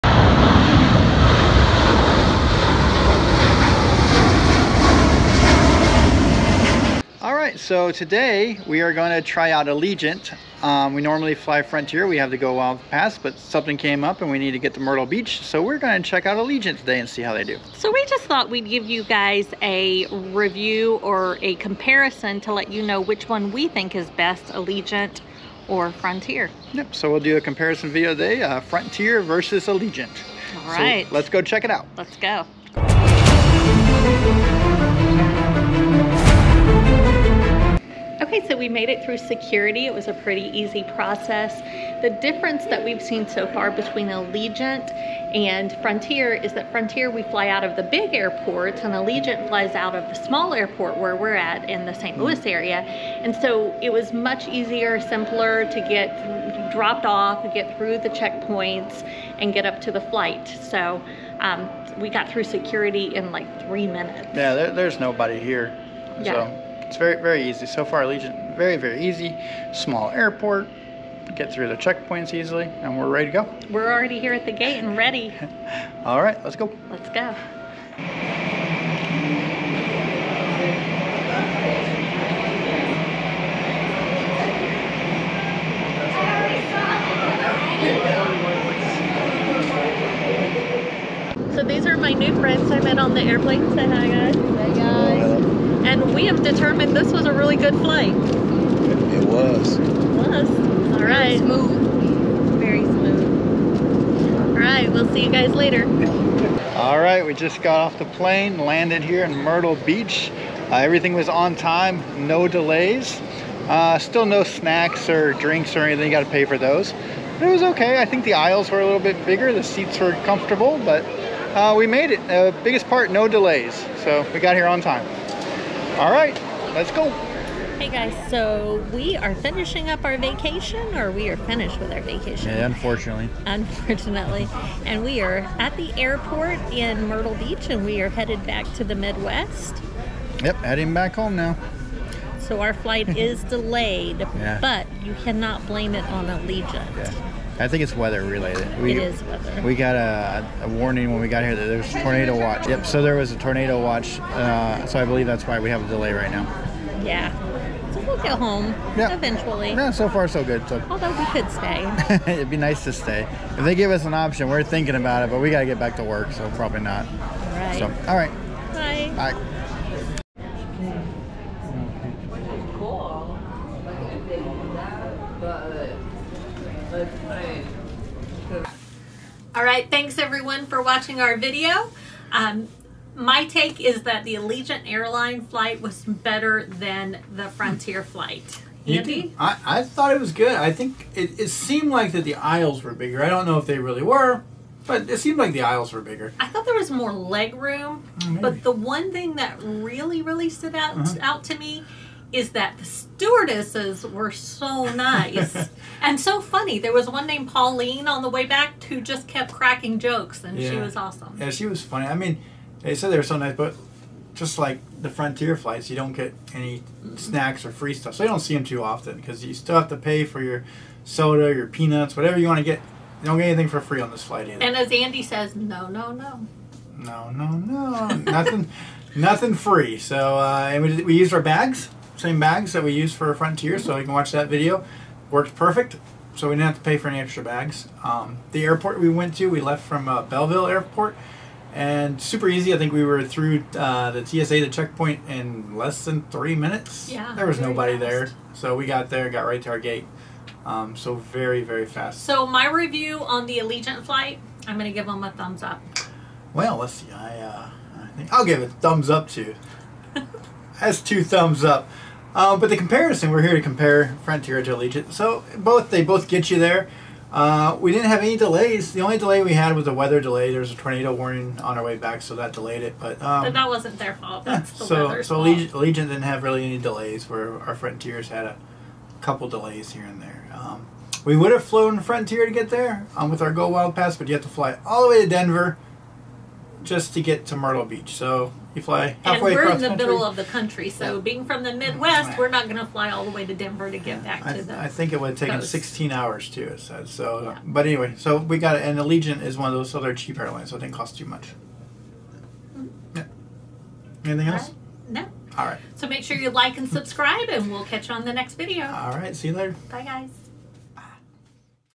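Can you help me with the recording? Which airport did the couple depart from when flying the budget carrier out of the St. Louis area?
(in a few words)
Belleville Airport.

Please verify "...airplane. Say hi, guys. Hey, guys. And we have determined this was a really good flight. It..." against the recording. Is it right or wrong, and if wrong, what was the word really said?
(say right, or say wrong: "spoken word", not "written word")
right.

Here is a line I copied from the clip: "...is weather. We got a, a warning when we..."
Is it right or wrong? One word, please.
right.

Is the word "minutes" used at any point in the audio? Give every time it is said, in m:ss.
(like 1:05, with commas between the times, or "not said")
1:03, 4:06.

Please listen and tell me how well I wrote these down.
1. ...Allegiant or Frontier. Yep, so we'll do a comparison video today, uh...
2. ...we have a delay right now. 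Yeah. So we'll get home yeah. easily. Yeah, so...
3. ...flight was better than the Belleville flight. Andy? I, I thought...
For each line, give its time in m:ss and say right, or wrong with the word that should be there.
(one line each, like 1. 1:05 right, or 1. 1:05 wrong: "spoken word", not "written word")
1. 0:24 right
2. 2:35 wrong: "eventually", not "easily"
3. 3:05 wrong: "Frontier", not "Belleville".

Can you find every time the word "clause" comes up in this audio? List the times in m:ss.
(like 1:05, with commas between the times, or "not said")
not said.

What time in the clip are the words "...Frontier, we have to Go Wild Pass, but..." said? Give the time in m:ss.
0:11.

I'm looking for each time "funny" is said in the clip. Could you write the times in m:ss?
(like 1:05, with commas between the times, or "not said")
3:26, 3:31.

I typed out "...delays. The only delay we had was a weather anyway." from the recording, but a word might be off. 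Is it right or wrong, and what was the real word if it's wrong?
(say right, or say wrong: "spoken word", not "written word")
wrong: "delay", not "anyway".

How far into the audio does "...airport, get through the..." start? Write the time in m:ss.
1:10.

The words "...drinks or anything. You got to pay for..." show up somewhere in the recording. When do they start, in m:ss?
1:55.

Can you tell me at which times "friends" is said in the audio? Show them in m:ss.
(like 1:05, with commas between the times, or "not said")
1:32.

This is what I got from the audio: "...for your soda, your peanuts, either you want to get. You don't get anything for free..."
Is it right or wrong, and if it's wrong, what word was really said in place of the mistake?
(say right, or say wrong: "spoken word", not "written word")
wrong: "whatever", not "either".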